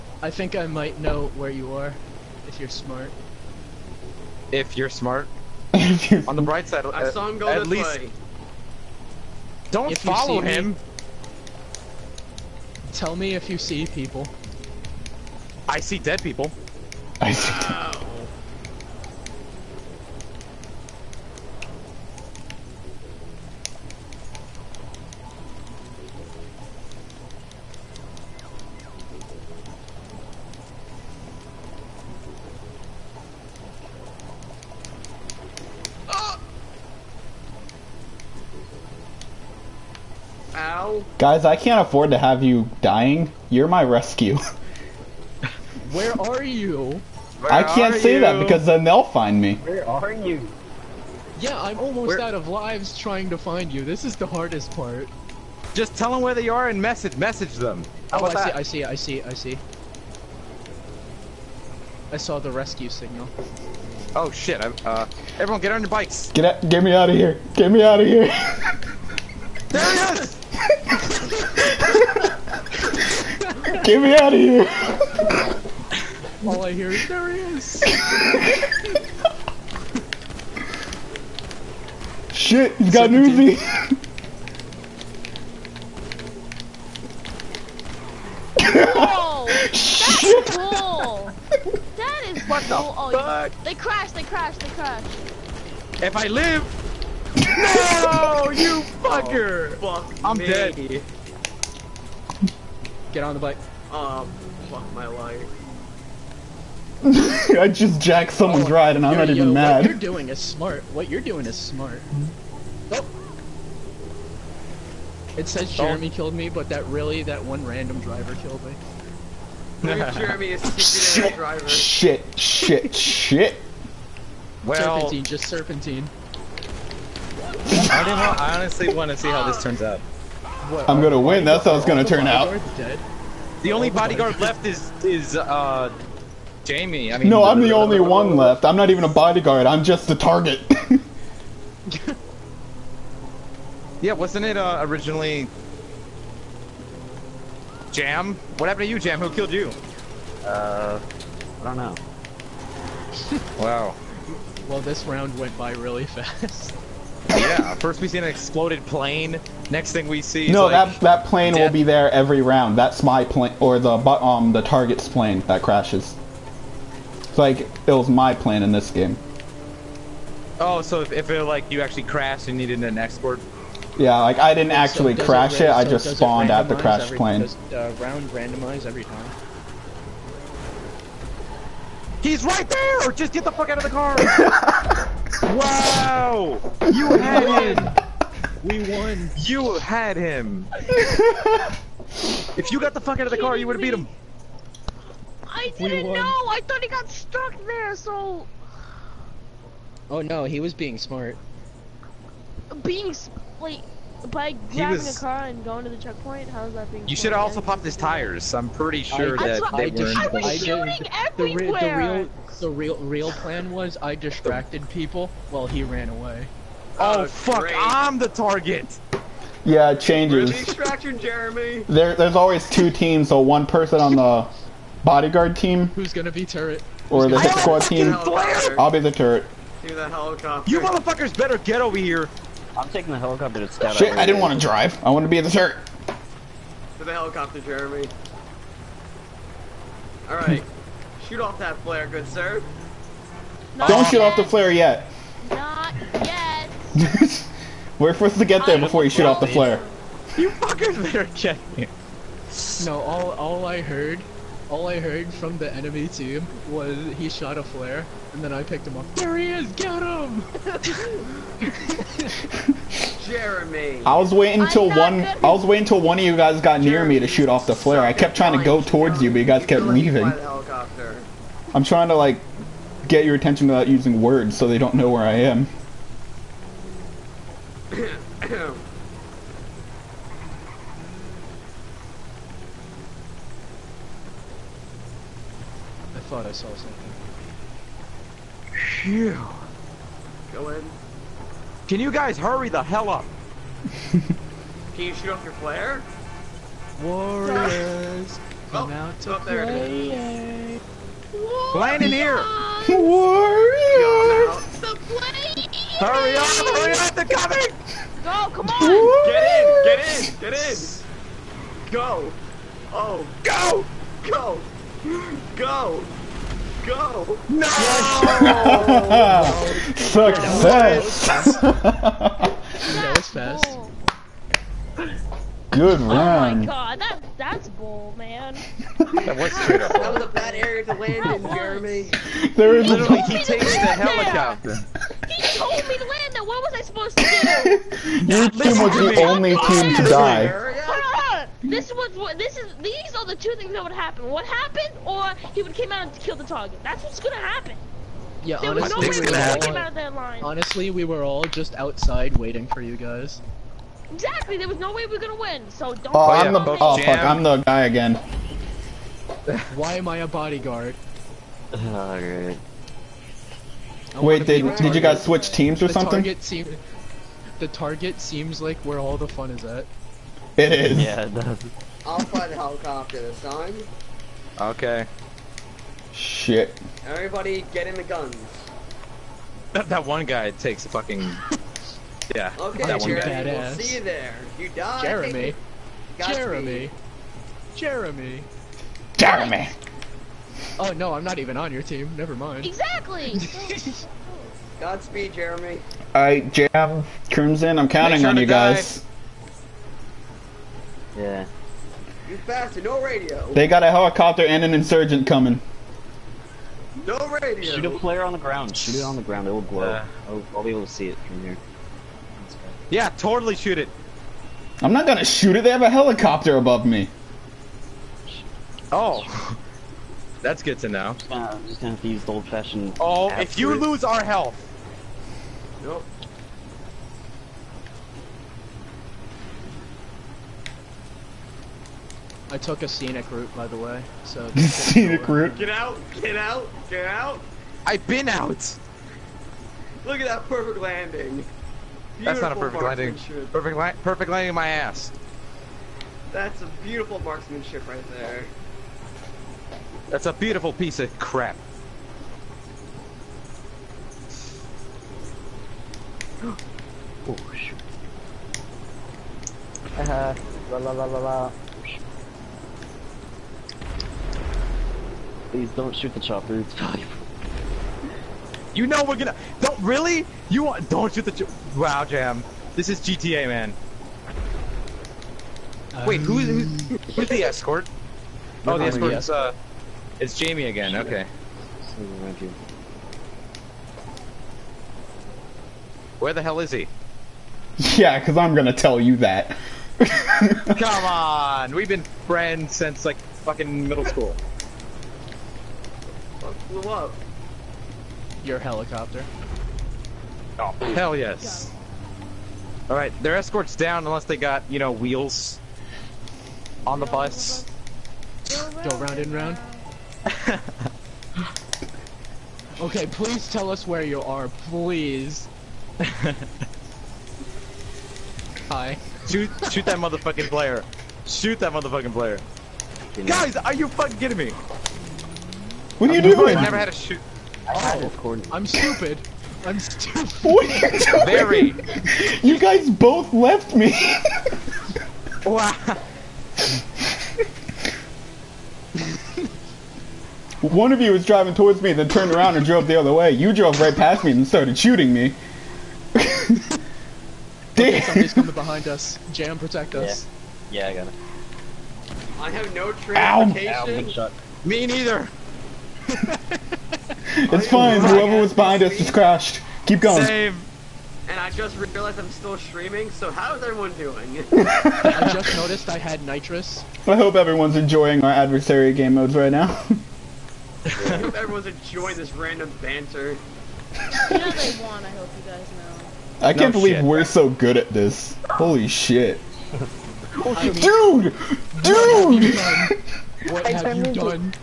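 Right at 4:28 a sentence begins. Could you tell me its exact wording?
I kept trying to go towards you, but you guys kept leaving.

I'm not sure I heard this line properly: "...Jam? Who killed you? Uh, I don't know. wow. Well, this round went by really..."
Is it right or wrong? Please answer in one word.
right.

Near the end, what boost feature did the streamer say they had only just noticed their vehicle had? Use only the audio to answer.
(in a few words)
Nitrous.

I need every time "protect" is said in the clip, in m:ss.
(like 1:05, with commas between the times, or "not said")
9:09.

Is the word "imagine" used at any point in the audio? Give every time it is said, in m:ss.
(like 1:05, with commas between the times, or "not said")
not said.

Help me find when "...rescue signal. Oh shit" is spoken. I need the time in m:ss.
1:02.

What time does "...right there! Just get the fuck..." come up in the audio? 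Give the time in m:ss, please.
3:02.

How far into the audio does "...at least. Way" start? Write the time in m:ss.
0:07.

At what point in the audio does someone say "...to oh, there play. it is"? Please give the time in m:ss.
4:59.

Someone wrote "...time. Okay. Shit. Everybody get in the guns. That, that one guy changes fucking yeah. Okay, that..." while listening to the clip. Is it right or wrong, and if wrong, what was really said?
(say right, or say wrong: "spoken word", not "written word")
wrong: "takes", not "changes".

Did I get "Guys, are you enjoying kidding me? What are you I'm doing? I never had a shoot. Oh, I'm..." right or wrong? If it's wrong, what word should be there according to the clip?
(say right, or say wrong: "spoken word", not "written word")
wrong: "fucking", not "enjoying".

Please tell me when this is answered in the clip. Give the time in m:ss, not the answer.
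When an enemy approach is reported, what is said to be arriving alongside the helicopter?
6:44.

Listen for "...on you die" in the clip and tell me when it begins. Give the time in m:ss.
6:38.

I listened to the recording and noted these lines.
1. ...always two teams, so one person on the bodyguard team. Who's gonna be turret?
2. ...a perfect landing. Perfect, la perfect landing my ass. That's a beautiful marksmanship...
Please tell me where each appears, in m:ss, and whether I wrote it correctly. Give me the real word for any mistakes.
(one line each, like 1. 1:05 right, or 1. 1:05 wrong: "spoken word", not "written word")
1. 3:42 right
2. 7:22 right.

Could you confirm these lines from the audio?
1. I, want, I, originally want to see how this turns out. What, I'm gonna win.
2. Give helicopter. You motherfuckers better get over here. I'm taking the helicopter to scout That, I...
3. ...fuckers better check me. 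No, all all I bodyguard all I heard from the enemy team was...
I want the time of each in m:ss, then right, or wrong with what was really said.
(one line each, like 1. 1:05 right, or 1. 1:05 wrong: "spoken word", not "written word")
1. 2:07 wrong: "honestly", not "originally"
2. 3:49 wrong: "Shit", not "That"
3. 4:10 wrong: "heard", not "bodyguard".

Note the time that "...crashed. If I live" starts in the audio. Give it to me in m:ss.
1:34.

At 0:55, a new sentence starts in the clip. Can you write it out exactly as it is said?
Just tell them where they are and message message them.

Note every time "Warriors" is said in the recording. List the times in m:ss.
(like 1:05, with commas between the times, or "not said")
4:57, 5:02, 5:08.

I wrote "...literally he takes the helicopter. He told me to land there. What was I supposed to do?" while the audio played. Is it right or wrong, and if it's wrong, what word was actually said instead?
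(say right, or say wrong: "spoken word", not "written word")
right.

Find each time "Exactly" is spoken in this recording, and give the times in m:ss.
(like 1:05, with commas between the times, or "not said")
5:54, 6:32.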